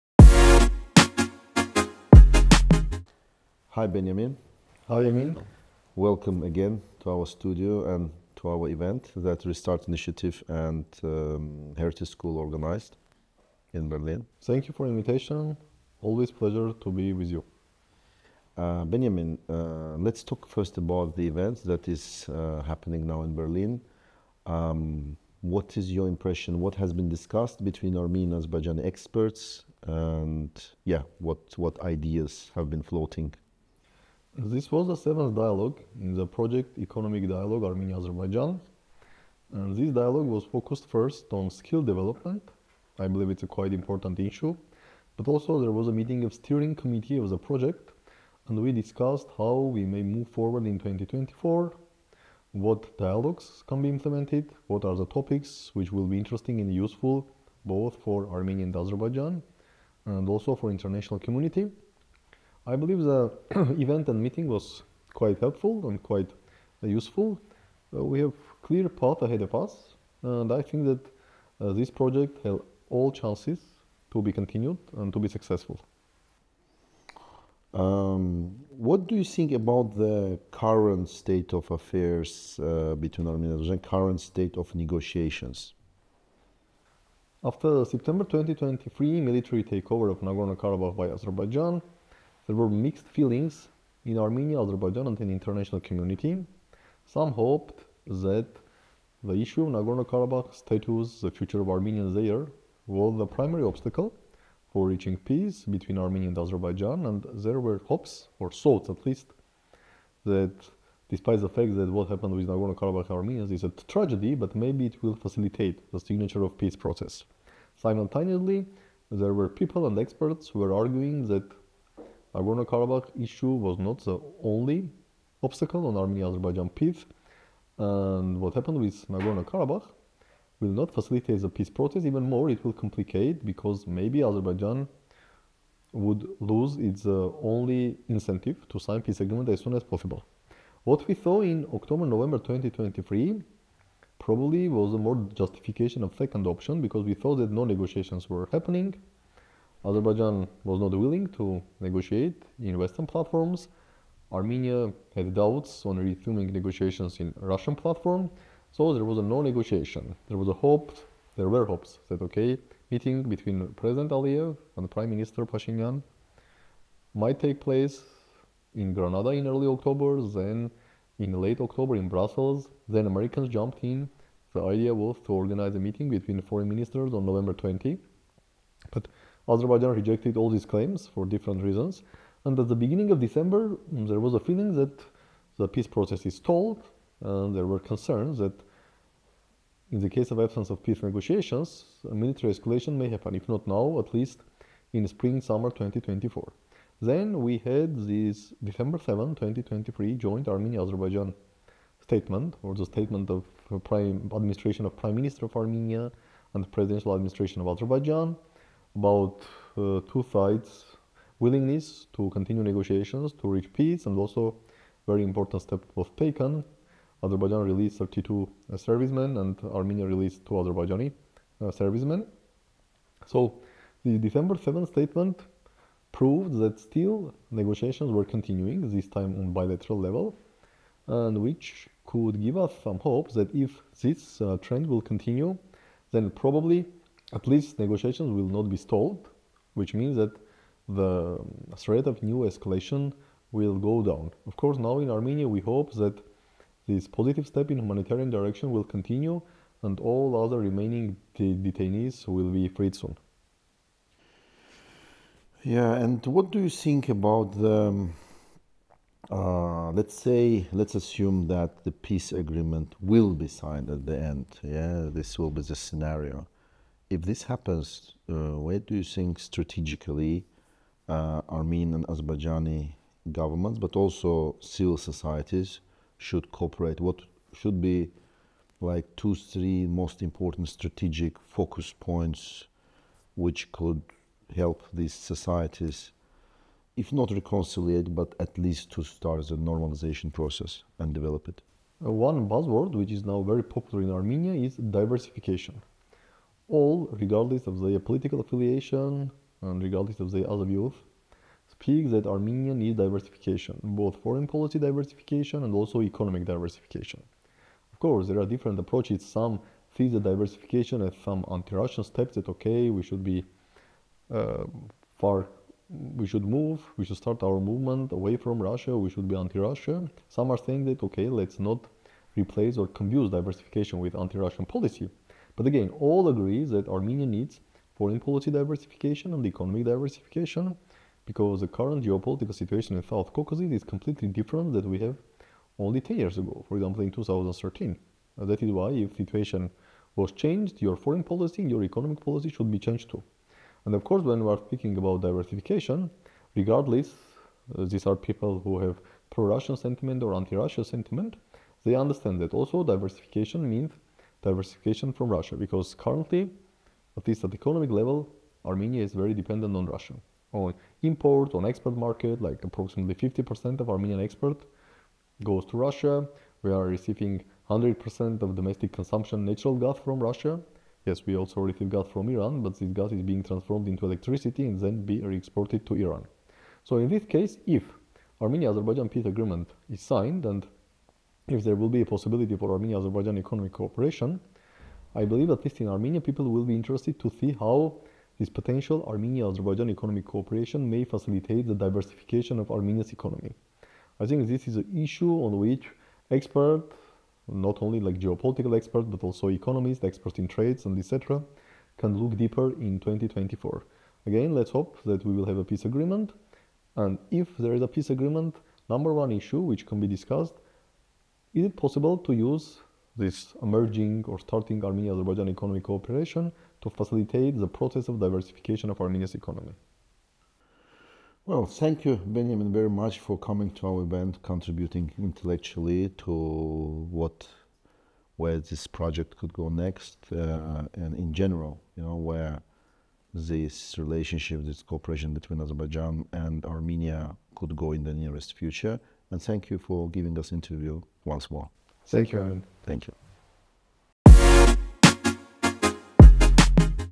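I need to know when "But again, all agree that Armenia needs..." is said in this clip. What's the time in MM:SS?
05:25.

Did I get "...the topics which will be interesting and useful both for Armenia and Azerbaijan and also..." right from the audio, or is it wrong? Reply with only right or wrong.
right.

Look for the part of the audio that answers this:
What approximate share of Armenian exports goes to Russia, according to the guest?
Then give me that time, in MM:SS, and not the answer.
06:03.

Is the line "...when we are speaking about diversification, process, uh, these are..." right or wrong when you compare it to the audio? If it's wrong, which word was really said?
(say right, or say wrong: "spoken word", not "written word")
wrong: "regardless", not "process".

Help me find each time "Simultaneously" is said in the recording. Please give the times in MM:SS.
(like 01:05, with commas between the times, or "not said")
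01:57.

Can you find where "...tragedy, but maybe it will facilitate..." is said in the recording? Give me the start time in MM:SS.
01:53.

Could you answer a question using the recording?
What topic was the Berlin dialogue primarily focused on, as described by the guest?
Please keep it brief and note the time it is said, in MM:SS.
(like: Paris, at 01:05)
skill development, at 00:41.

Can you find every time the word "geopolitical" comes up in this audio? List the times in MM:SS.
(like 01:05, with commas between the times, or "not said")
05:32, 06:38.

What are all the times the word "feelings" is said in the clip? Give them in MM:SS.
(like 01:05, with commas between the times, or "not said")
01:33, 03:04.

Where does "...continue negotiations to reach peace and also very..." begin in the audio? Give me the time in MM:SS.
03:32.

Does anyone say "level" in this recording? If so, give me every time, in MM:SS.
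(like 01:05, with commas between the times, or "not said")
03:49, 05:57.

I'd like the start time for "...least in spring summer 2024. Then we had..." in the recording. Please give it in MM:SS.
03:14.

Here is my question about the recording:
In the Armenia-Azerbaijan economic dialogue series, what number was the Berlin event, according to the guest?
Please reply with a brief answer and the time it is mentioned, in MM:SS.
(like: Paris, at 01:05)
seventh, at 00:34.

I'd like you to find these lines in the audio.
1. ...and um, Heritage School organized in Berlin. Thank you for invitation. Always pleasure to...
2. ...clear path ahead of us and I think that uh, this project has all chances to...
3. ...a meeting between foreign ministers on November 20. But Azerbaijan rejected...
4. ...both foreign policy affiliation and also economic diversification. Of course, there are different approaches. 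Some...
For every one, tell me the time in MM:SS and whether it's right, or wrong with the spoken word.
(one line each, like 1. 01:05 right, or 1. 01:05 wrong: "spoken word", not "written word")
1. 00:10 right
2. 01:08 right
3. 02:55 right
4. 05:03 wrong: "diversification", not "affiliation".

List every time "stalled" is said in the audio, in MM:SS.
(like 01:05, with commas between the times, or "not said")
03:06, 03:58.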